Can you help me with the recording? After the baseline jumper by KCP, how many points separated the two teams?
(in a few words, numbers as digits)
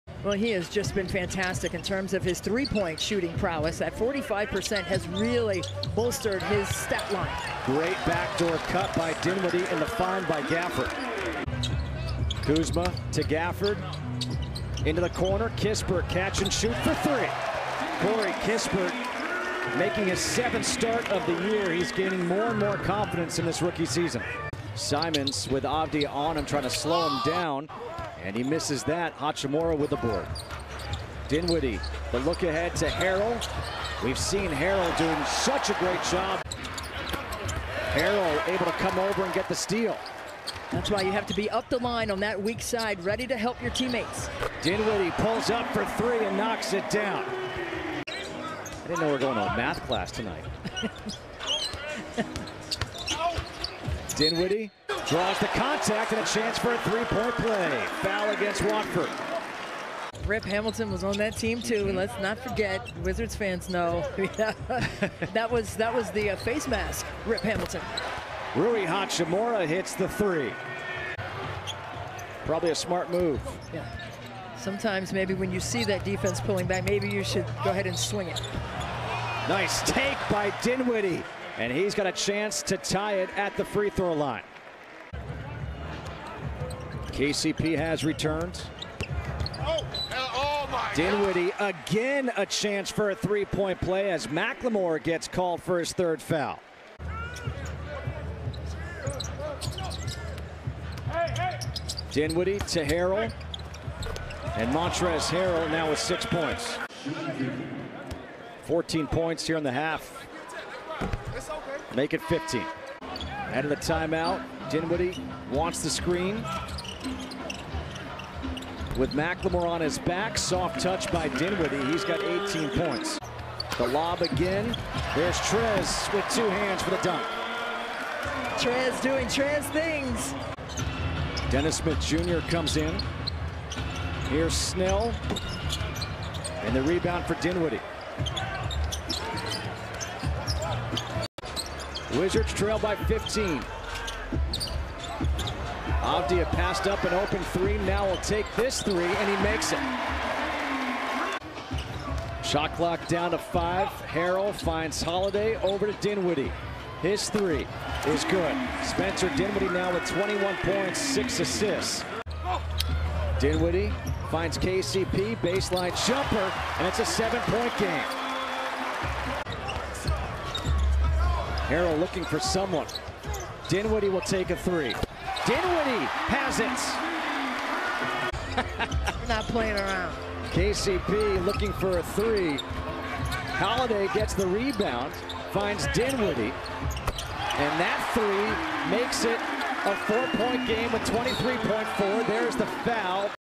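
7.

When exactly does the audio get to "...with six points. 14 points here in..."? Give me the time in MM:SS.
01:45.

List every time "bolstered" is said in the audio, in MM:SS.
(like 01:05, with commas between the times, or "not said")
00:05.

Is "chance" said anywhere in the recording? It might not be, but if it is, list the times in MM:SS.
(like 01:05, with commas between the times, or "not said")
00:56, 01:22, 01:32.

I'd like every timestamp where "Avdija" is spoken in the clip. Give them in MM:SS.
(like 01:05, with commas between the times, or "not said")
00:25, 02:26.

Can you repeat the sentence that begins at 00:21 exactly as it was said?
He's gaining more and more confidence in this rookie season.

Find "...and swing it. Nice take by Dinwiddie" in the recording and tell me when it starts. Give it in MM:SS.
01:17.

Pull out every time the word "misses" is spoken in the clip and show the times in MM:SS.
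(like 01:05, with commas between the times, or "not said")
00:28.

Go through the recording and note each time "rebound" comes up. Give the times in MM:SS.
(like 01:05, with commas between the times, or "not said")
02:16, 03:04.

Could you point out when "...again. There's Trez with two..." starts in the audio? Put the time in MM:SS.
02:04.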